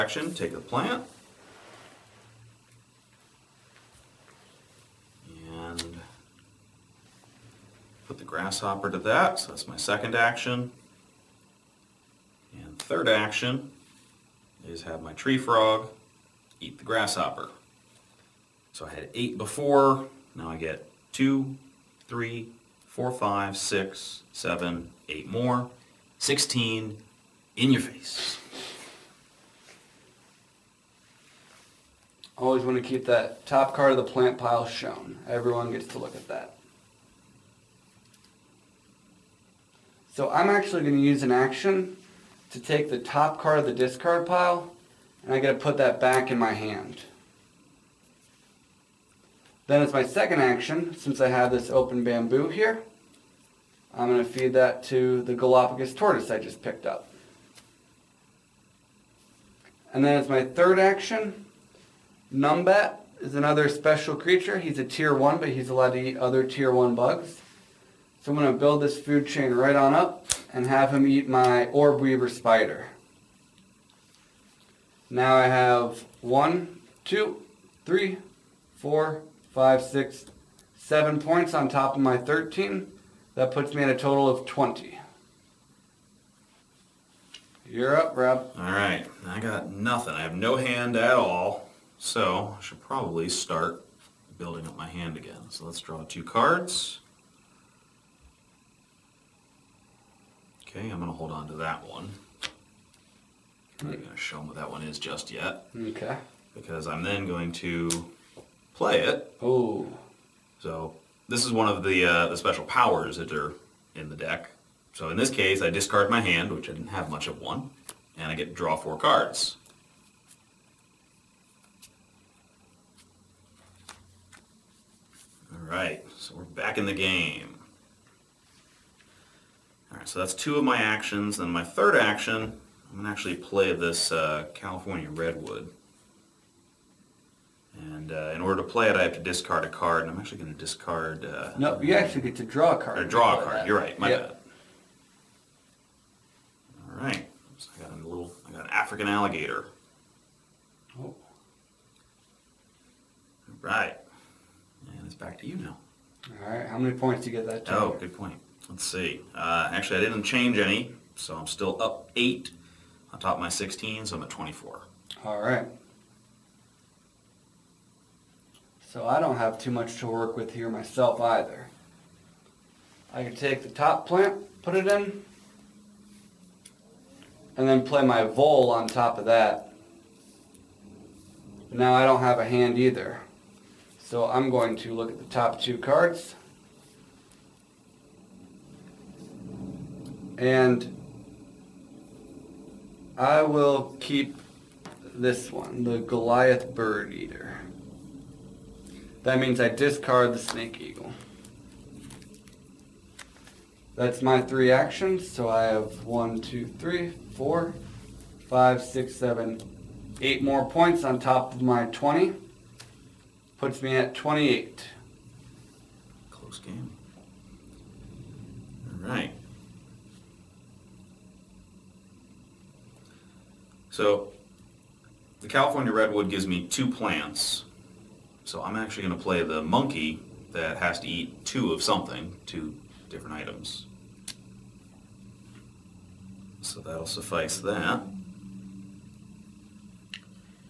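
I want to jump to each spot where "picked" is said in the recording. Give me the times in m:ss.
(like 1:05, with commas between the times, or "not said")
0:56.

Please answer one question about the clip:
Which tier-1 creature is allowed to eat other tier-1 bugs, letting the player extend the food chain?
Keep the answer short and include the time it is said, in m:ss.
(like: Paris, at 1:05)
Numbat, at 1:02.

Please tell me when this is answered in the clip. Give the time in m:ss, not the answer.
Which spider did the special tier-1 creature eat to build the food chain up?
1:11.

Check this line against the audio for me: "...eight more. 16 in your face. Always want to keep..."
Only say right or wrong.
right.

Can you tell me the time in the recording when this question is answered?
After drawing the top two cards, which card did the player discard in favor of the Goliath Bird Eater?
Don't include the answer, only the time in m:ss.
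3:20.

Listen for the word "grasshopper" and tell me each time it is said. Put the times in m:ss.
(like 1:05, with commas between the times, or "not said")
0:08, 0:16.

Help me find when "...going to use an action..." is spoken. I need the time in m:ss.
0:40.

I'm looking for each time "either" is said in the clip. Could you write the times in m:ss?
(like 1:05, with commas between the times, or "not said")
2:51, 3:02.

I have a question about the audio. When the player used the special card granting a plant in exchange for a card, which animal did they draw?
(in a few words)
African alligator.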